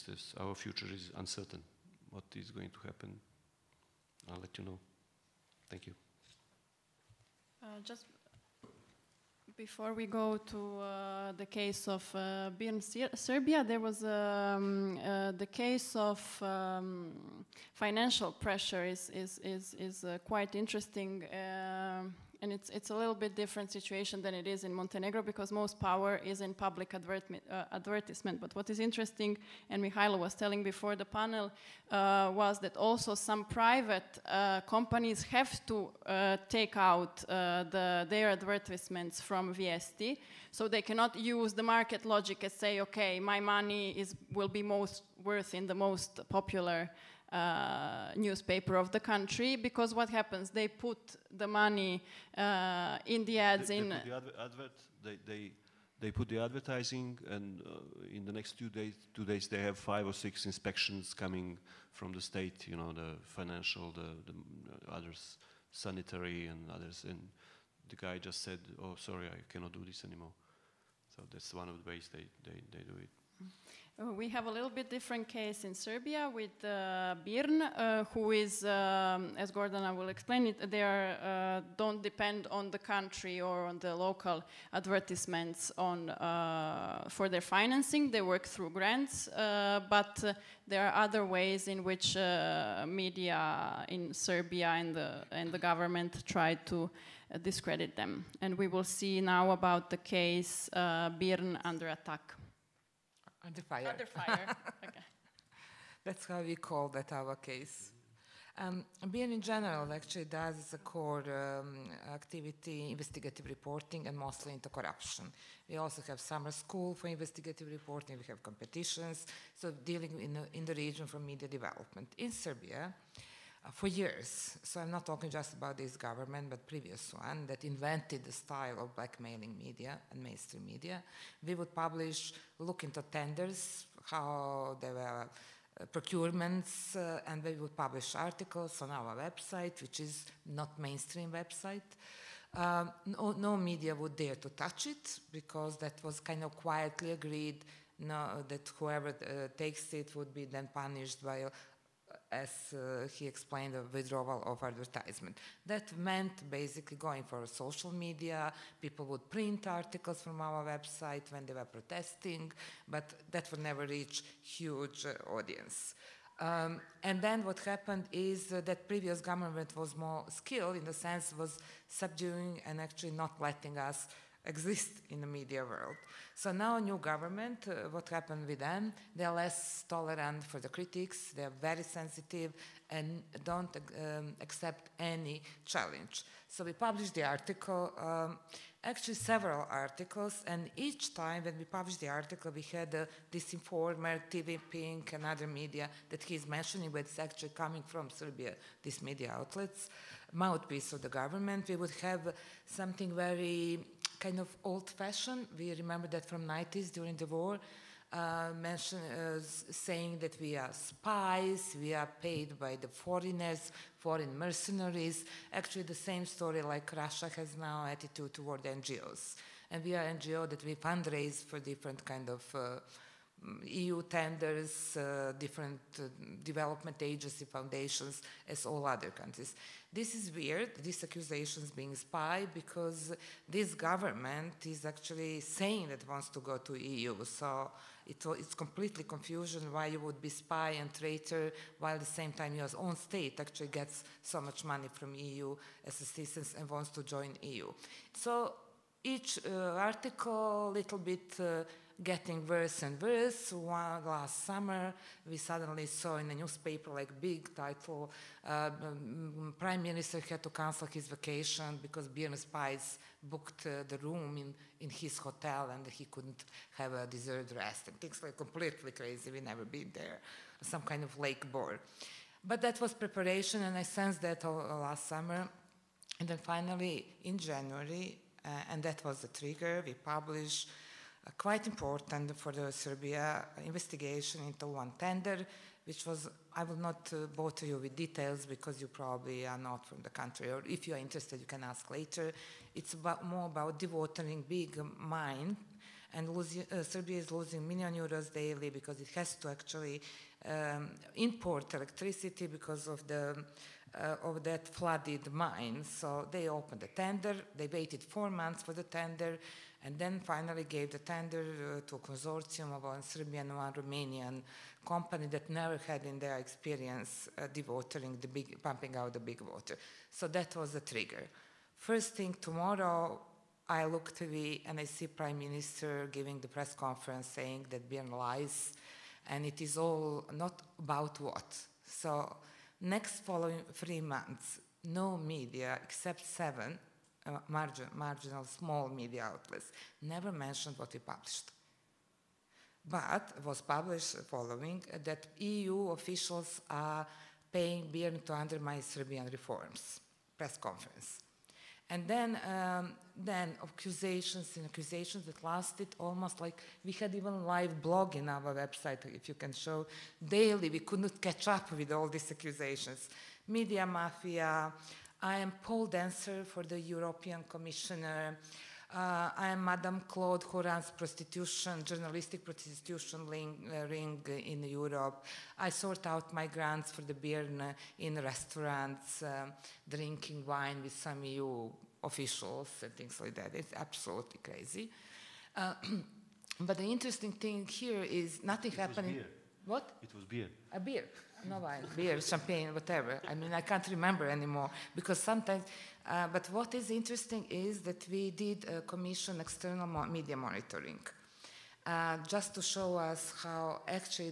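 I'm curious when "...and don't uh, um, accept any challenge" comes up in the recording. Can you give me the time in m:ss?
3:02.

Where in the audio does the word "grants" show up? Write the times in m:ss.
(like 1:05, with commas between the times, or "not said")
1:28, 6:16.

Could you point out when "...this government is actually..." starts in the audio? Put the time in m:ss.
3:53.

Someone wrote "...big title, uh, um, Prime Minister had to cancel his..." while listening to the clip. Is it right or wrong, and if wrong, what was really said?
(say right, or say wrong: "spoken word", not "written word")
right.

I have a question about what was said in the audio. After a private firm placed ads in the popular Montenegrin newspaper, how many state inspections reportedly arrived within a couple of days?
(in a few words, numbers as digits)
5 or 6.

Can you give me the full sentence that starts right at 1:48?
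Um, in general actually does as a core um, activity investigative reporting and mostly into corruption.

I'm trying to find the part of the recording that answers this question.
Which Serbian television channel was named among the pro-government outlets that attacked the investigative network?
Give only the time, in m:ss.
3:14.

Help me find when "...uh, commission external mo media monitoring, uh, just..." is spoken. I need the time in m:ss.
6:38.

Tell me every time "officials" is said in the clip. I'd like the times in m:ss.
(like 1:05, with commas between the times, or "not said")
5:45, 6:22.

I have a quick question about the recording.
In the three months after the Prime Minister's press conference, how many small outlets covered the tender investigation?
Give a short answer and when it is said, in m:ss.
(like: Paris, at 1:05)
7, at 5:36.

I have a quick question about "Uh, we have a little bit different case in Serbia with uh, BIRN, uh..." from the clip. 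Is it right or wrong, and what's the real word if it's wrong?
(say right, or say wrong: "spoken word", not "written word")
right.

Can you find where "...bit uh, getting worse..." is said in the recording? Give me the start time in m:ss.
4:10.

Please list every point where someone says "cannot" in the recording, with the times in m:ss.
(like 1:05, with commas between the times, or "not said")
0:40, 1:09.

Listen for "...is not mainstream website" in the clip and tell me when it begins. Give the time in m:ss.
2:19.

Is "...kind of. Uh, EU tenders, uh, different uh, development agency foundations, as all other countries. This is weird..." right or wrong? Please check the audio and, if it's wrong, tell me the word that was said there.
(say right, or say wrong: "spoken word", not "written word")
right.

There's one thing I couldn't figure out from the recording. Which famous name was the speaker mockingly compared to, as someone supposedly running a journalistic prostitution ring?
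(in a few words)
Madame Claude.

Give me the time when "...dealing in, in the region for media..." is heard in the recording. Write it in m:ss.
1:59.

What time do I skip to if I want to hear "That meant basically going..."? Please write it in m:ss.
2:35.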